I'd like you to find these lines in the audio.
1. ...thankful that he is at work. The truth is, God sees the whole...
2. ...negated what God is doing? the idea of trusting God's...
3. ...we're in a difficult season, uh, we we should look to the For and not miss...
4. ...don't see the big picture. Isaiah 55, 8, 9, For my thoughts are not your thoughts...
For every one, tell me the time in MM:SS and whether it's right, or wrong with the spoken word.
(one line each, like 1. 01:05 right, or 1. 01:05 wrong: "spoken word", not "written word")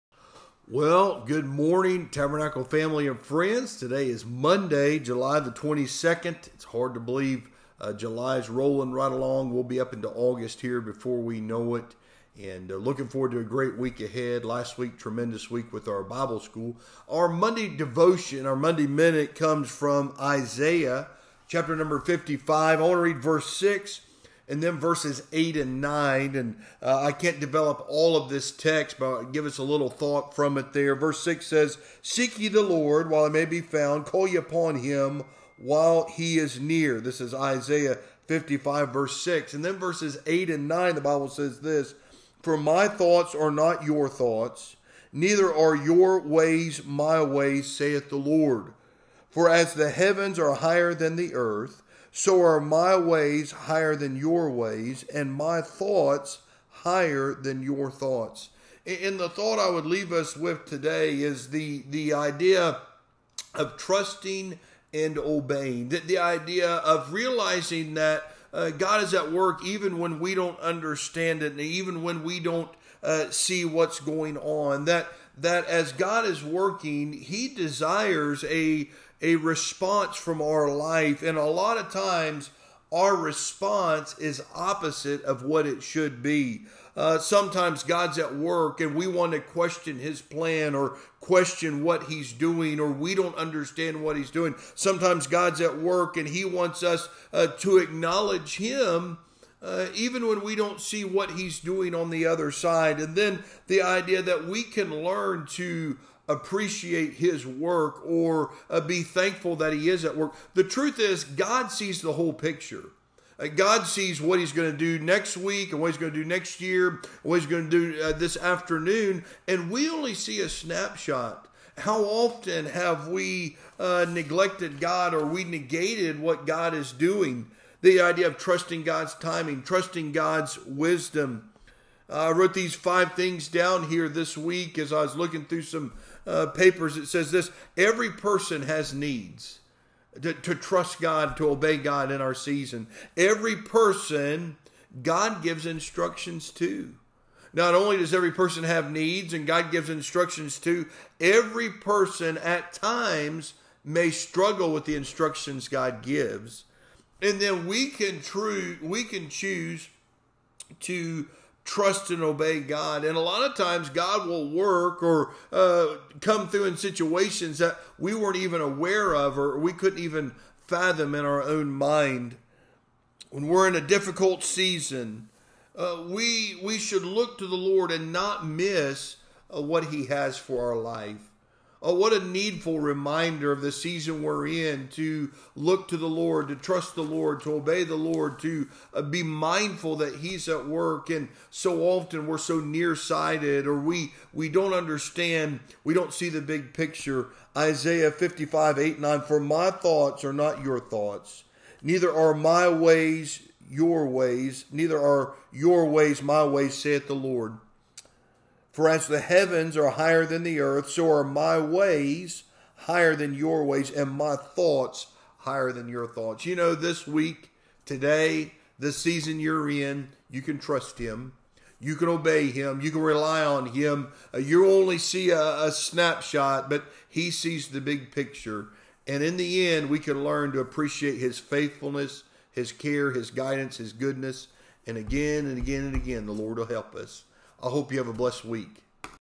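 1. 01:49 right
2. 02:05 right
3. 02:53 wrong: "Lord", not "For"
4. 03:15 right.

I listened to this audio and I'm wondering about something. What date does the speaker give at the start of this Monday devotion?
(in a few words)
Monday, July 22.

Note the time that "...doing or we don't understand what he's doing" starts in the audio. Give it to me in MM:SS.
01:32.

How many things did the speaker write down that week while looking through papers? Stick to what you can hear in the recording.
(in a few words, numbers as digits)
5.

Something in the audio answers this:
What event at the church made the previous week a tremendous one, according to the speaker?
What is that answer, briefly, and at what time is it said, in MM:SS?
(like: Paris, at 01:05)
Bible school, at 00:16.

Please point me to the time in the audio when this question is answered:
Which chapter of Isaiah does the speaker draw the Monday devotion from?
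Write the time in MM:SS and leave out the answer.
00:21.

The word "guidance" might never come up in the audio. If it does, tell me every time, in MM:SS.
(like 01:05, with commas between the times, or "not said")
03:53.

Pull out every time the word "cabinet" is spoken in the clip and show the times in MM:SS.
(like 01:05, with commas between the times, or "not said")
not said.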